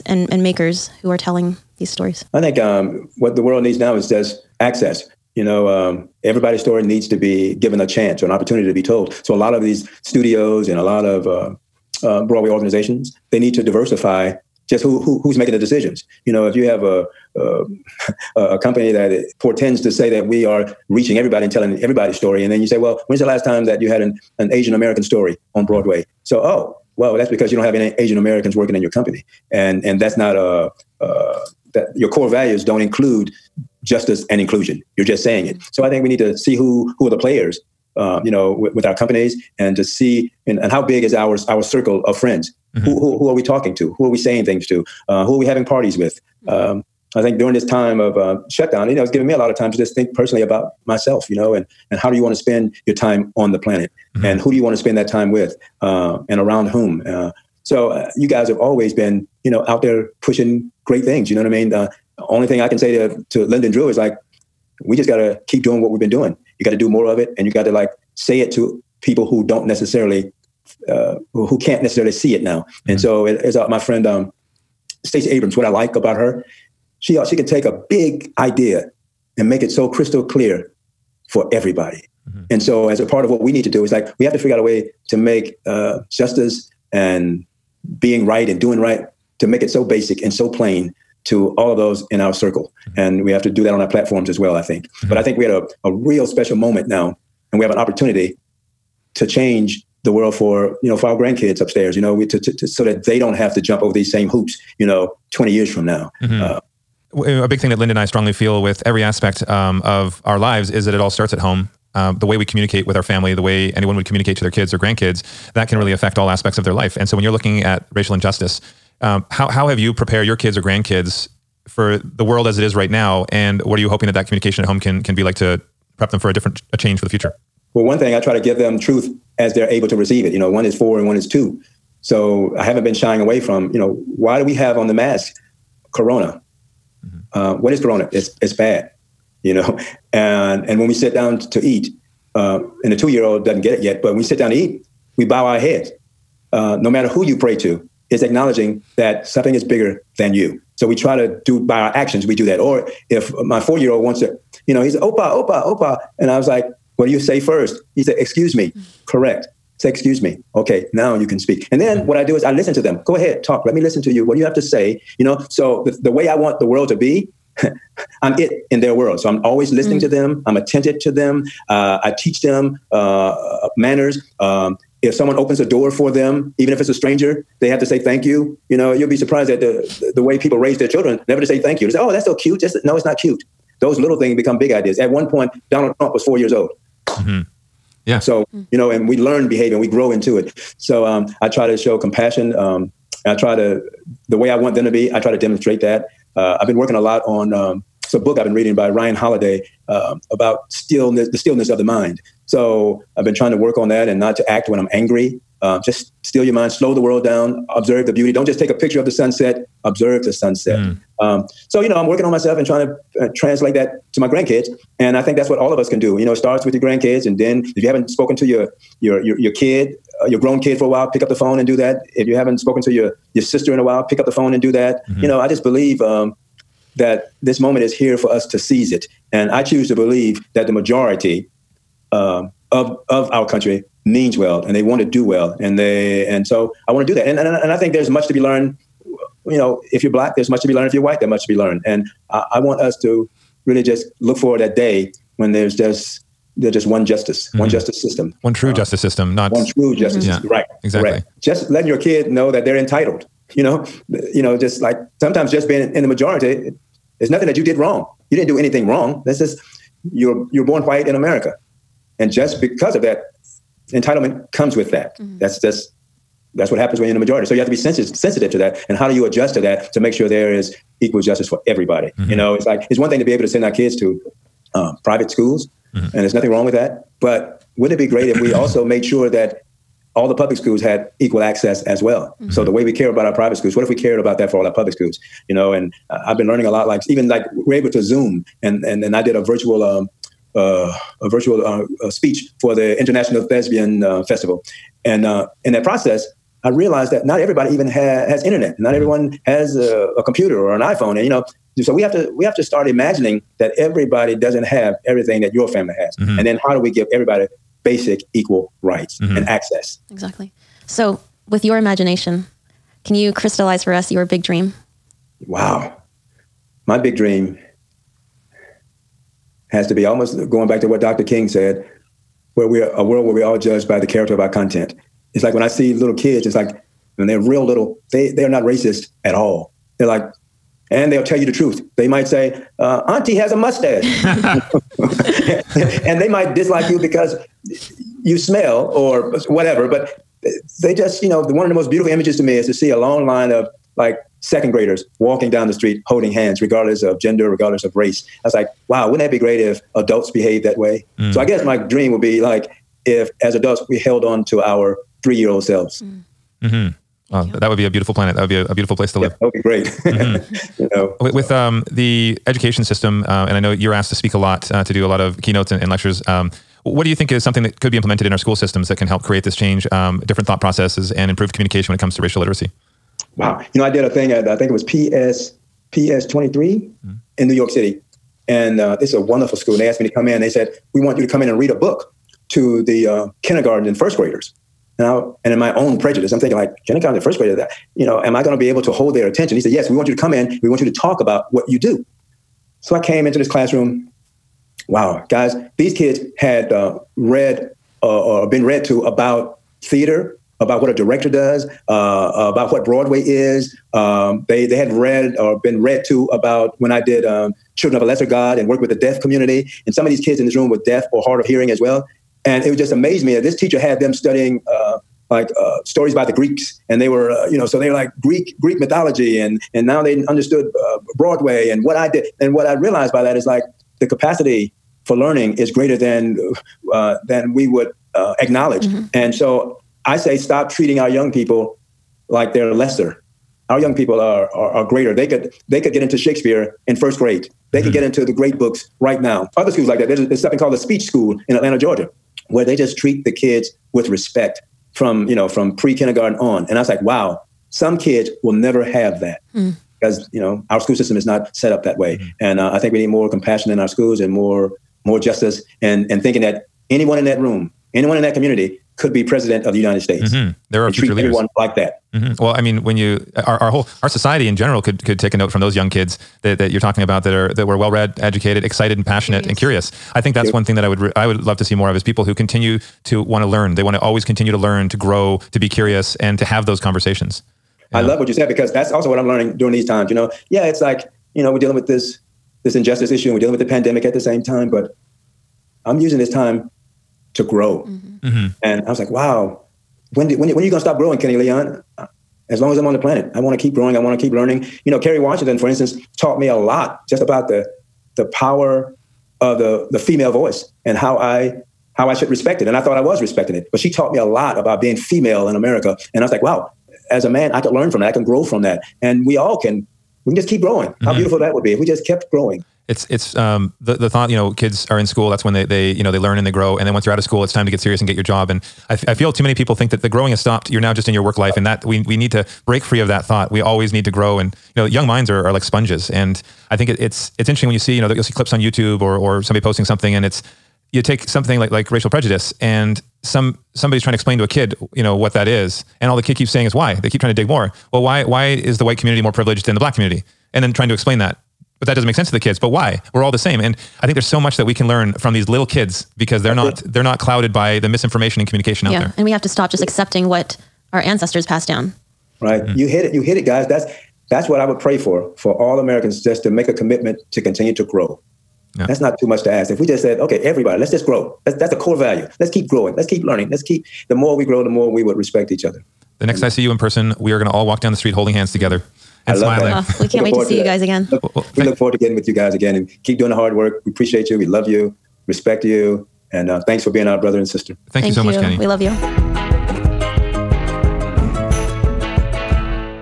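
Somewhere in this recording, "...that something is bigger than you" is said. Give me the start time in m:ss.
2:28.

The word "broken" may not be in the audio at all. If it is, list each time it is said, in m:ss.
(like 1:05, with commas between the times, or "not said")
not said.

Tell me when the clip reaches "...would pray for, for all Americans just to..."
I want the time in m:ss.
9:14.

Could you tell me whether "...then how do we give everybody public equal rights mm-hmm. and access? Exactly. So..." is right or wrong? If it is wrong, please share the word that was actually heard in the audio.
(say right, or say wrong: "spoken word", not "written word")
wrong: "basic", not "public".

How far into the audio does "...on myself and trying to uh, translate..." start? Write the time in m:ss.
3:32.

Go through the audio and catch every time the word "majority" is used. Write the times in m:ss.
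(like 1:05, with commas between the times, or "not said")
3:50, 4:16, 4:27.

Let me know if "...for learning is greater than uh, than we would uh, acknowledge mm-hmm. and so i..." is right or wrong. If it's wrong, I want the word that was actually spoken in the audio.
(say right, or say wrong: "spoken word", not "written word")
right.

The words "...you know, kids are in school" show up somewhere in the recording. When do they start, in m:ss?
8:34.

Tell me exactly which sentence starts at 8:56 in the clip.
They keep trying to dig more well, why why is the white community more privileged than the black community?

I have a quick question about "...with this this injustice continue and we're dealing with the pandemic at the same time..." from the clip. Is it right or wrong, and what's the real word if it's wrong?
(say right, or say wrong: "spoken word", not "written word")
wrong: "issue", not "continue".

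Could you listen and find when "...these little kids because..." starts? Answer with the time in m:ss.
9:05.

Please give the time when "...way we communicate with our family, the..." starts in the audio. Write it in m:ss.
1:52.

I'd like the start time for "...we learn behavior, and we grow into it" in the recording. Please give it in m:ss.
3:09.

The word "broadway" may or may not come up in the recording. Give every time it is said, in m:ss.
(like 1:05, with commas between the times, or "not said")
0:12, 0:25, 6:42, 7:01.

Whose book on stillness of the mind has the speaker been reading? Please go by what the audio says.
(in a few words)
Ryan Holiday.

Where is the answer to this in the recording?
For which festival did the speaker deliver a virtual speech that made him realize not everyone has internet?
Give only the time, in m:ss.
4:52.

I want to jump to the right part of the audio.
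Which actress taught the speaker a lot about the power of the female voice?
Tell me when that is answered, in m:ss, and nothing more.
8:14.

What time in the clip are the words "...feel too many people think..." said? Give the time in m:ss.
8:39.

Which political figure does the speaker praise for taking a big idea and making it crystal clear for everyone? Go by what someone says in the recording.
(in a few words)
Stacey Abrams.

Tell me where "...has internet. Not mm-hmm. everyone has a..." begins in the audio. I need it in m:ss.
4:58.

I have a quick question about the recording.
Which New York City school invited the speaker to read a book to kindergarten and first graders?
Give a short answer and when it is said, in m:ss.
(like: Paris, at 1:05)
PS23, at 6:15.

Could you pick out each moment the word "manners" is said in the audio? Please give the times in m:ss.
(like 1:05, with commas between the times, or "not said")
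2:53.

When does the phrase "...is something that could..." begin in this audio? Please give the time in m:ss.
6:07.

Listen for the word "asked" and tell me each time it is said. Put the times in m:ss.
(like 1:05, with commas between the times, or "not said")
6:03, 6:19.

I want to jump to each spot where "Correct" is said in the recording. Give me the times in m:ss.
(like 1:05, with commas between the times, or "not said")
2:39, 4:11.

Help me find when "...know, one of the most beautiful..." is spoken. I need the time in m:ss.
5:41.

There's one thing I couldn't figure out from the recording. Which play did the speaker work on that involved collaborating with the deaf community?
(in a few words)
Children of a Lesser God.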